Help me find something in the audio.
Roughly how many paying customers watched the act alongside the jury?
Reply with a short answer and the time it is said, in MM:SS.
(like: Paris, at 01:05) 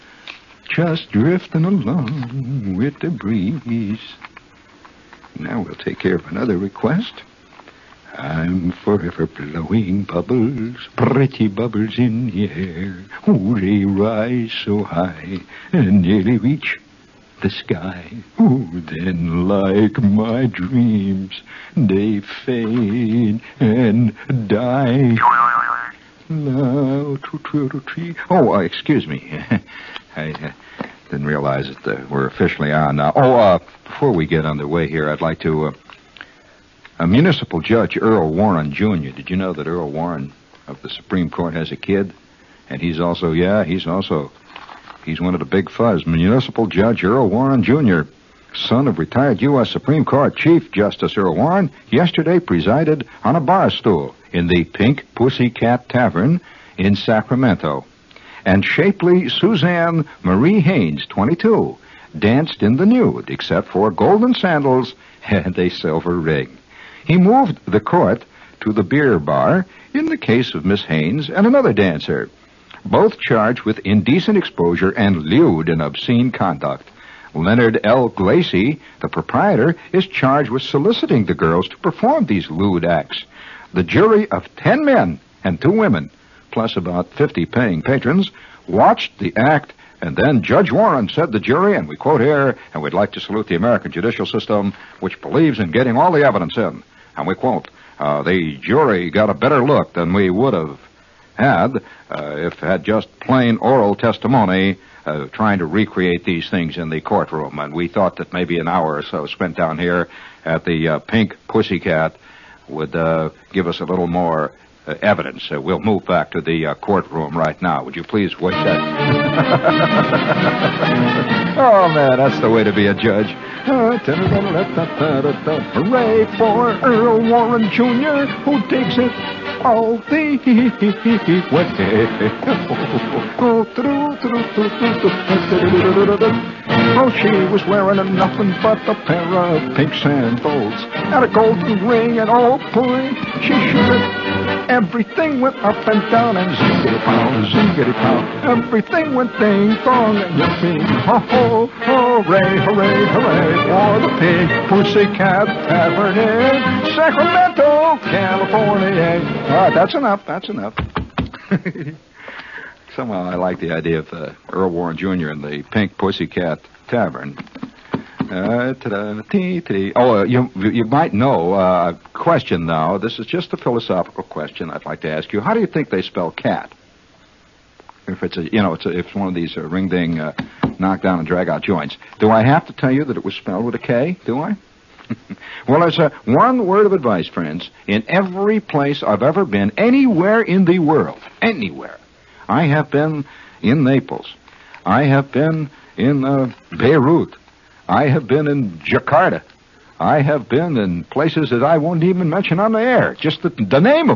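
50, at 01:27.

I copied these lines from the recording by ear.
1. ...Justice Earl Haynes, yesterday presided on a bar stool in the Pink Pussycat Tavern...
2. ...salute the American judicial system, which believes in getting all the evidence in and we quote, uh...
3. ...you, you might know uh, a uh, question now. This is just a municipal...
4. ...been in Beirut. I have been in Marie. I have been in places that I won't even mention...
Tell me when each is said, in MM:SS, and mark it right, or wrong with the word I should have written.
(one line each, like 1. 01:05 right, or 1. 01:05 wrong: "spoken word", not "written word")
1. 00:50 wrong: "Warren", not "Haynes"
2. 01:33 right
3. 02:50 wrong: "philosophical", not "municipal"
4. 03:15 wrong: "Jakarta", not "Marie".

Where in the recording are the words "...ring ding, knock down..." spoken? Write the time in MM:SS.
02:59.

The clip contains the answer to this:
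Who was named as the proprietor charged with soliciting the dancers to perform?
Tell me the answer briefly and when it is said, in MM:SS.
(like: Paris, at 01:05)
Leonard L. Glacy, at 01:17.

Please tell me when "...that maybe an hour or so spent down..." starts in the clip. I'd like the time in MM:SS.
01:48.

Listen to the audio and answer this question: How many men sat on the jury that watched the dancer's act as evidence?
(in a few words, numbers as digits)
10.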